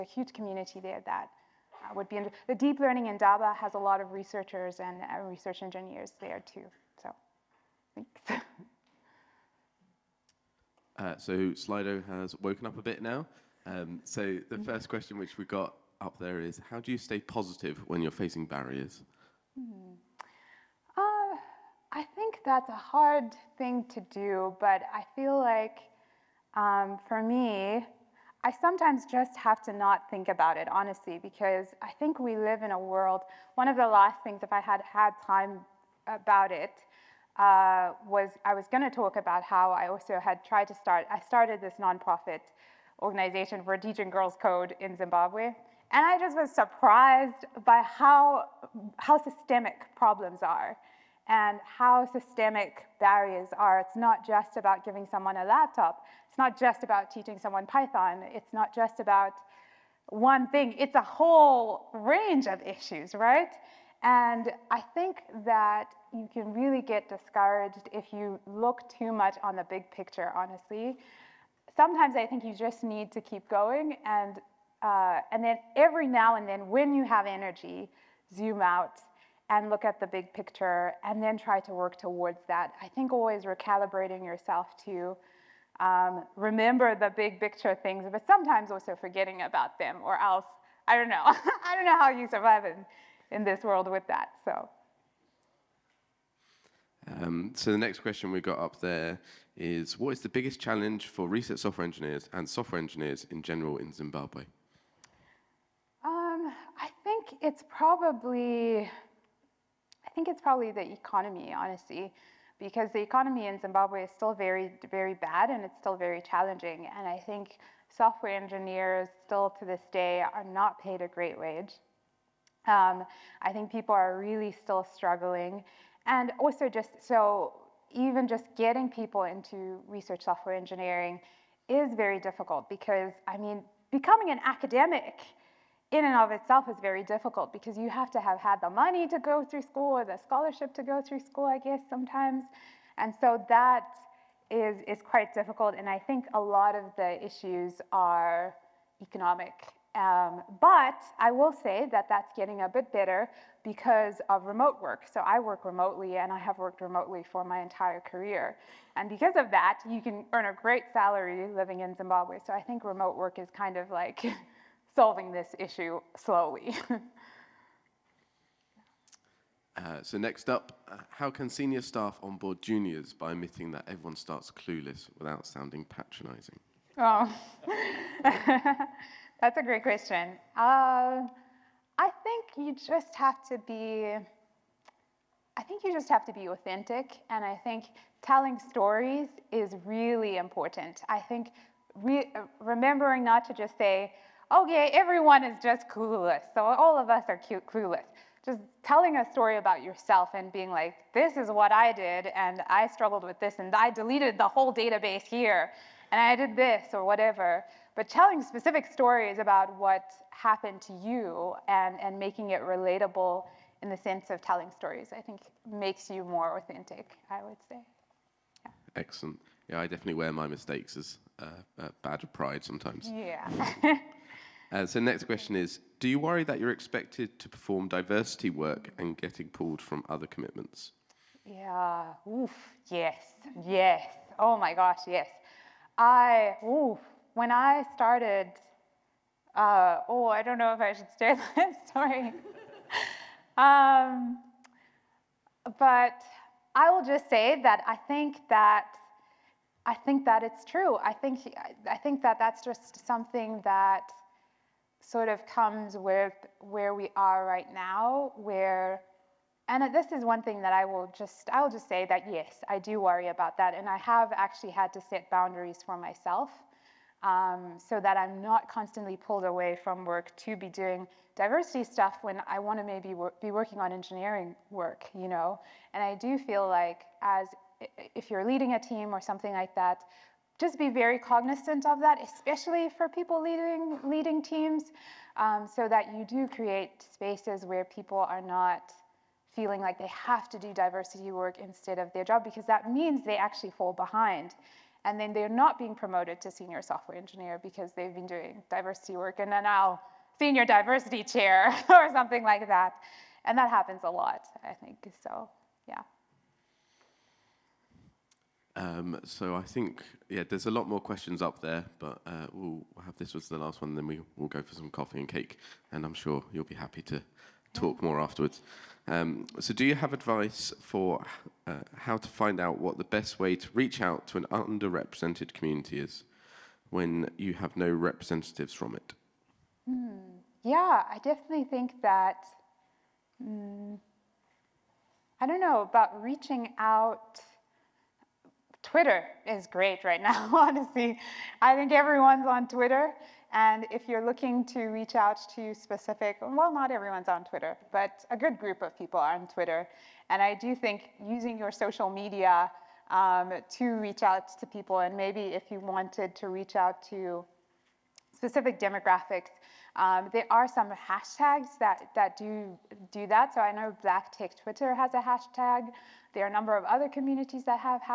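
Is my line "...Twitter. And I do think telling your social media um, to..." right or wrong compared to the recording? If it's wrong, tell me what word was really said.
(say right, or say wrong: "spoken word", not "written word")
wrong: "using", not "telling".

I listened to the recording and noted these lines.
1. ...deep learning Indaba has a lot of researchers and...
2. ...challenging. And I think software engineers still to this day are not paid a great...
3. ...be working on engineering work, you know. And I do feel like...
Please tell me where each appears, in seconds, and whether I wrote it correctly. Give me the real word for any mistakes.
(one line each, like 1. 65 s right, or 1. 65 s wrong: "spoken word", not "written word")
1. 2 s right
2. 116 s right
3. 273 s right.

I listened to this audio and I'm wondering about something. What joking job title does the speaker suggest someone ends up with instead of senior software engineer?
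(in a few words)
Senior diversity chair.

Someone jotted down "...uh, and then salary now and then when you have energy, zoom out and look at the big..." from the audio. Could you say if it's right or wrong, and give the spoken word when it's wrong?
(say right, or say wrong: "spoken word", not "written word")
wrong: "every", not "salary".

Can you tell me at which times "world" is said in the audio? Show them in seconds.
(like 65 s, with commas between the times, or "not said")
32 s, 93 s.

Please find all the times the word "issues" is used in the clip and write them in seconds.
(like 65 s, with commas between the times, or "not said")
62 s, 147 s, 165 s.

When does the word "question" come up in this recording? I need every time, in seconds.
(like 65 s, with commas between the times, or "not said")
14 s, 98 s, 179 s, 225 s, 311 s.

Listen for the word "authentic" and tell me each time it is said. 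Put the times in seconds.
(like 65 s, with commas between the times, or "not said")
186 s, 216 s.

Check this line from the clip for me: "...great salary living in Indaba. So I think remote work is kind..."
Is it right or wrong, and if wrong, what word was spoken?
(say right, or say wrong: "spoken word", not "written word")
wrong: "Zimbabwe", not "Indaba".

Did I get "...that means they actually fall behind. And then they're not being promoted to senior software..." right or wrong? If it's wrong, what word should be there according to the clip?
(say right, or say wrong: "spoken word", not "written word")
right.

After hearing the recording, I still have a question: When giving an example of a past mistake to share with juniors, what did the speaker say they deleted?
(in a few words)
The whole database.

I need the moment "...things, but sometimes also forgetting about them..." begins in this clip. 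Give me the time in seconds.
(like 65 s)
87 s.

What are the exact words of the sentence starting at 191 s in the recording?
I think re uh, remembering not to just say, okay, everyone is just clueless.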